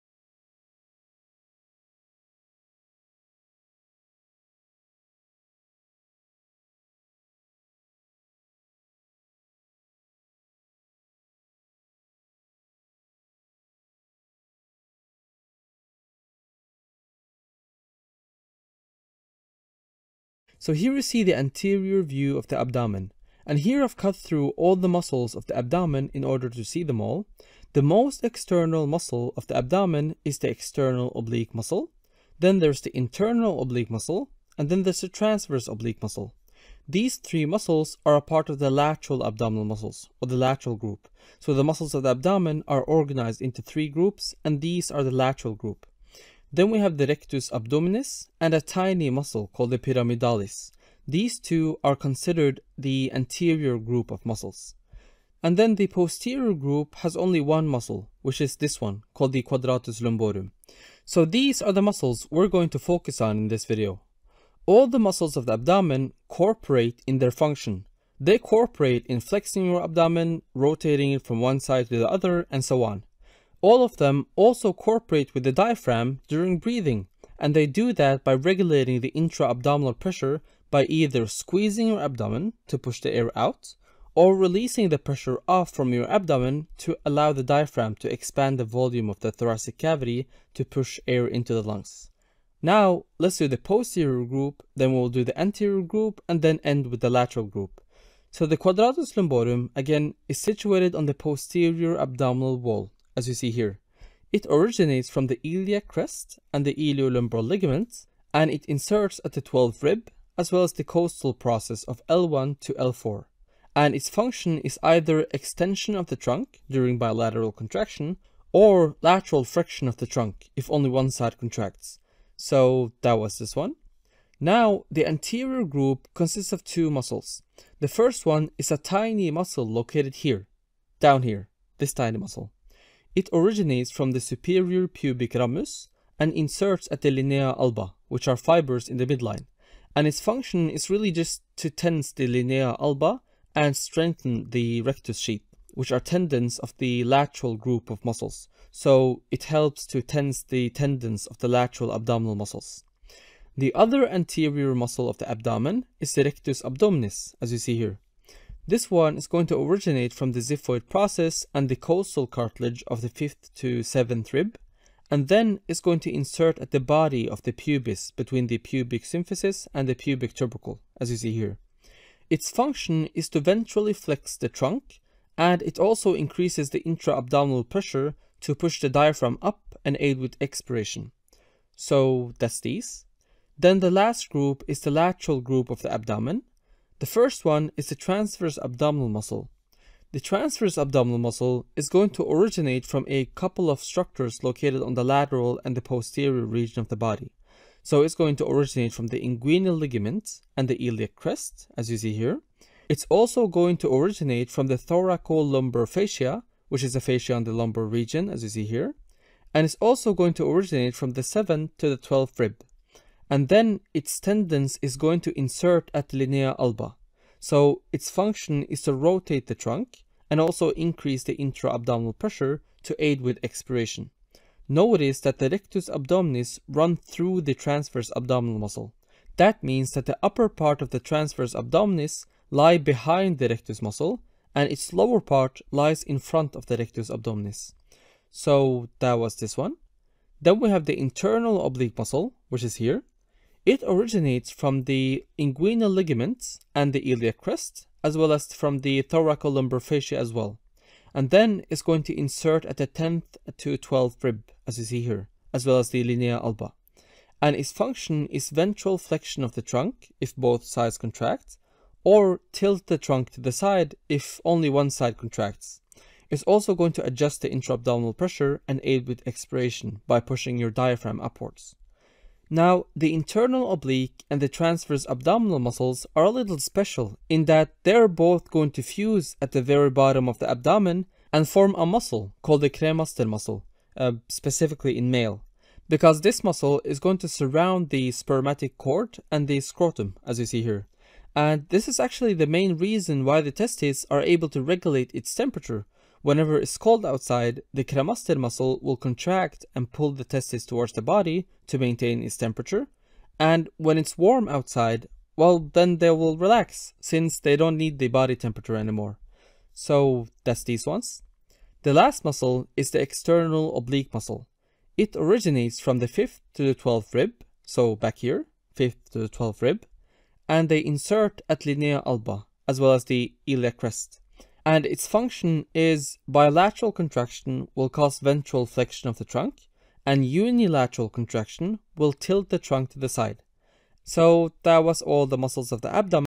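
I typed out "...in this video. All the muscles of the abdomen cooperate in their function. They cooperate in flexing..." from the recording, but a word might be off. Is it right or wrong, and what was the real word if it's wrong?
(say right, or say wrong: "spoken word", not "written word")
right.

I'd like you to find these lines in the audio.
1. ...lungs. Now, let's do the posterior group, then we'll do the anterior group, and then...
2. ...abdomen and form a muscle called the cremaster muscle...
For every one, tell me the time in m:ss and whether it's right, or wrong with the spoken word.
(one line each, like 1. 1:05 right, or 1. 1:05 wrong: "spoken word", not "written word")
1. 1:31 right
2. 4:40 right.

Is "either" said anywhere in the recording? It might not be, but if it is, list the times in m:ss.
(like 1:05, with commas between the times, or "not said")
1:20, 1:54.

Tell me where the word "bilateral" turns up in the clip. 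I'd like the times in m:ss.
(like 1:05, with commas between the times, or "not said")
1:56, 5:26.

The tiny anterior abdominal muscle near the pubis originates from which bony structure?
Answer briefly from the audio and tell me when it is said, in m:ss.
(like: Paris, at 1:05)
Superior pubic ramus, at 2:14.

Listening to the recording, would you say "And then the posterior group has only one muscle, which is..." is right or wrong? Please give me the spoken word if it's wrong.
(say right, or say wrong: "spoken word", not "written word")
right.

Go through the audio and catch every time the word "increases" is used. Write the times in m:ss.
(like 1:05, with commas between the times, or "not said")
2:56, 3:40.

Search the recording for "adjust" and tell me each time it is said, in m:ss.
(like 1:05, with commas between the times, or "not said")
4:27.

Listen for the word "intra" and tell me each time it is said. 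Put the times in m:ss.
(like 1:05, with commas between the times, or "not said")
1:19, 2:56, 3:41, 4:27.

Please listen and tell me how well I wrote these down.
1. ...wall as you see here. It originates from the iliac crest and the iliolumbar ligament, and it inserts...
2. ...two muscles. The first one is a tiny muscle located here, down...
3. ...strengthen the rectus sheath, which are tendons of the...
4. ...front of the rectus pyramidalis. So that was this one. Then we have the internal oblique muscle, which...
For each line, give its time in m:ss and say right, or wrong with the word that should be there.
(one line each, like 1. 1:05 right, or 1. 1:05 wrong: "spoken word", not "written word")
1. 1:42 right
2. 2:06 right
3. 2:23 right
4. 3:56 wrong: "abdominis", not "pyramidalis".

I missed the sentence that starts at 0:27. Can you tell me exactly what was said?
The most external muscle of the abdomen is the external oblique muscle.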